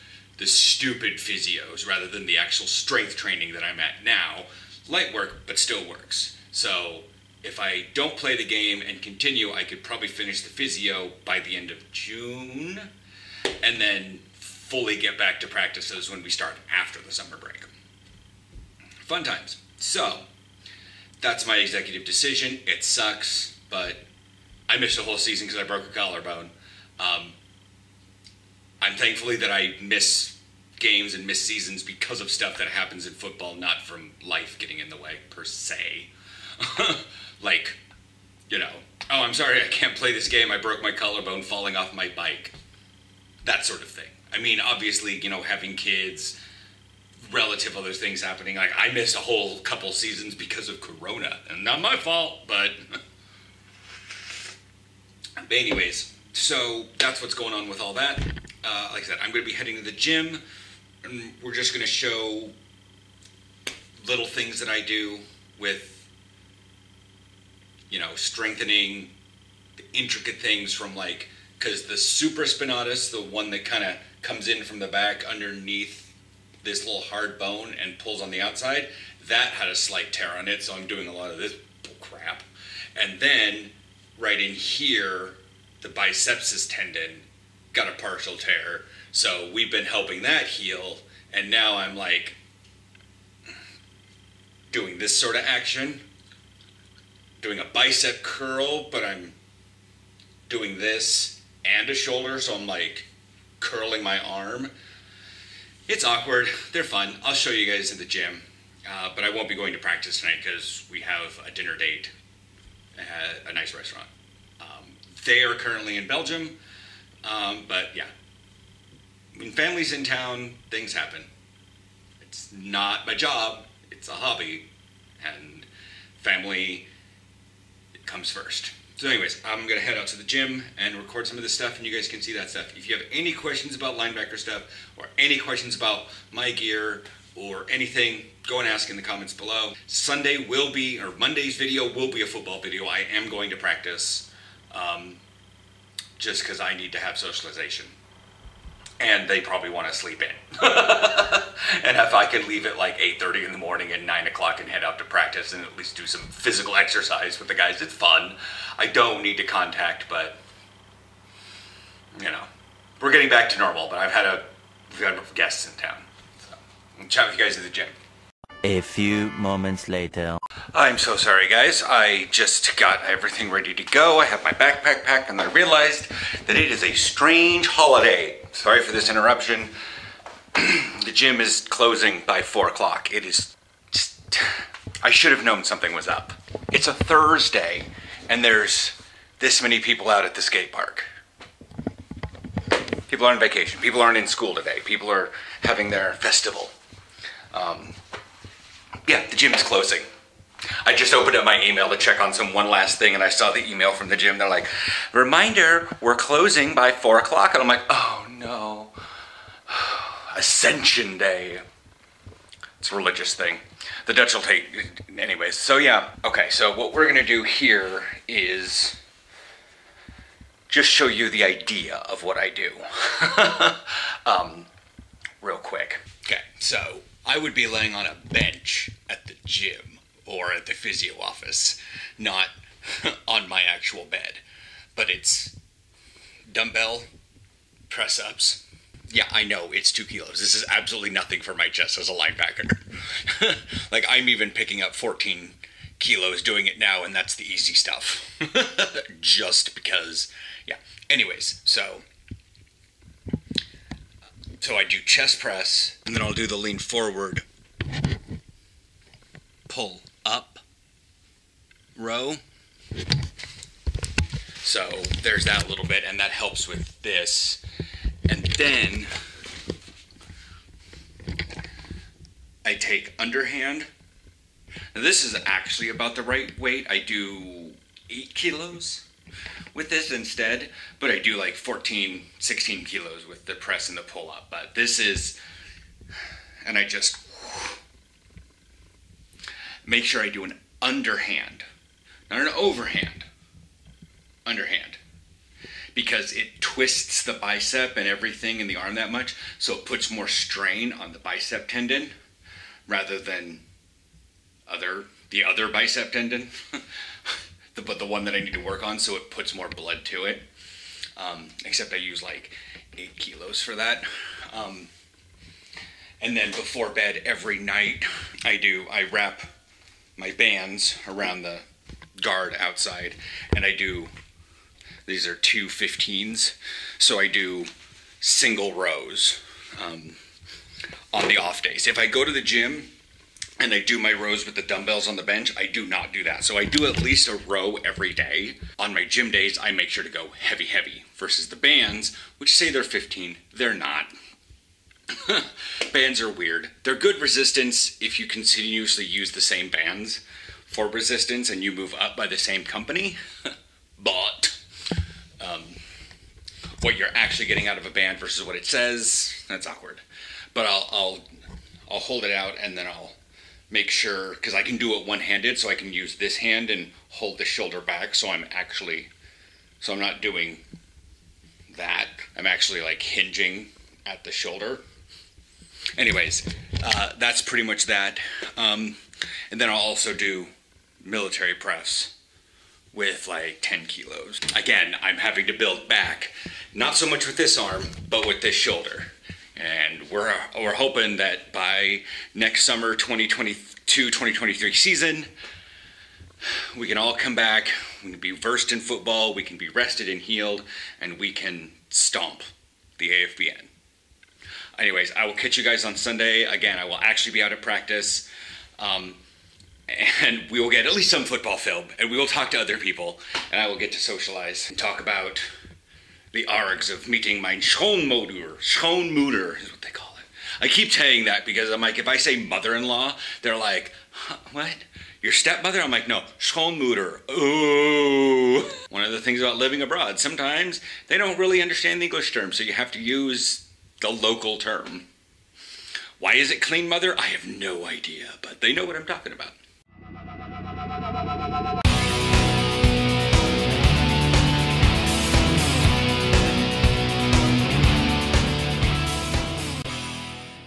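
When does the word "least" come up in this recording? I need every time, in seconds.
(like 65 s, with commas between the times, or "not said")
155 s, 337 s, 410 s.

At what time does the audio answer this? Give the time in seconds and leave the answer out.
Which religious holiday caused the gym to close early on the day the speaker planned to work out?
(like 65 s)
210 s.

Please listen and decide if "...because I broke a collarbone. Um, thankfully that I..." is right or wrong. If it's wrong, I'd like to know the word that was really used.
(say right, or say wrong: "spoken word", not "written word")
right.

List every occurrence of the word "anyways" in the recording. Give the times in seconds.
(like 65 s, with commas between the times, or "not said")
55 s, 129 s, 215 s, 251 s, 375 s, 404 s.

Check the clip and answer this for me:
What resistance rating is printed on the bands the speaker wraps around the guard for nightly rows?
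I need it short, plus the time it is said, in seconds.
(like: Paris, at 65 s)
15, at 325 s.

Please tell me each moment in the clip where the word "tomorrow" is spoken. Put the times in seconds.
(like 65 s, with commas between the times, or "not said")
not said.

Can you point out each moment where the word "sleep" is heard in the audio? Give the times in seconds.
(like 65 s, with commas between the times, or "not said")
149 s.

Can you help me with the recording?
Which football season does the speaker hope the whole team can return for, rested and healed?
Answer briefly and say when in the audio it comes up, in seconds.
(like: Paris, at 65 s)
2022-2023, at 392 s.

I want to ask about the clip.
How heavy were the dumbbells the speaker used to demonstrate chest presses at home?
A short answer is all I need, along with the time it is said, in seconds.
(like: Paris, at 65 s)
2 kilos, at 239 s.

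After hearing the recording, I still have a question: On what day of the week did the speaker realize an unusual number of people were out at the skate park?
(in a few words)
Thursday.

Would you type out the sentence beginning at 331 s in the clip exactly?
If I go to the gym and I do my rows with the dumbbells on the bench, I do not do that.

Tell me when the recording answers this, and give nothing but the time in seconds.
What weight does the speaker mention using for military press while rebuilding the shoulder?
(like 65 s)
383 s.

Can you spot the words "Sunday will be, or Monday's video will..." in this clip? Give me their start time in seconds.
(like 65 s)
139 s.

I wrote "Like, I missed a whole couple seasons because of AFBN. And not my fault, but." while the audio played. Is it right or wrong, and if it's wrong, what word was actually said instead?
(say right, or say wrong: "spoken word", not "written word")
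wrong: "Corona", not "AFBN".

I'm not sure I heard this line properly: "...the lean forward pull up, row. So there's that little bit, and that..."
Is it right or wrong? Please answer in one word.
right.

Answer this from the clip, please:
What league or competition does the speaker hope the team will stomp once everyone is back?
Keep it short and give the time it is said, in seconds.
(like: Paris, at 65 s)
AFBN, at 403 s.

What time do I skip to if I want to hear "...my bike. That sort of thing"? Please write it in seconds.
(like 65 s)
41 s.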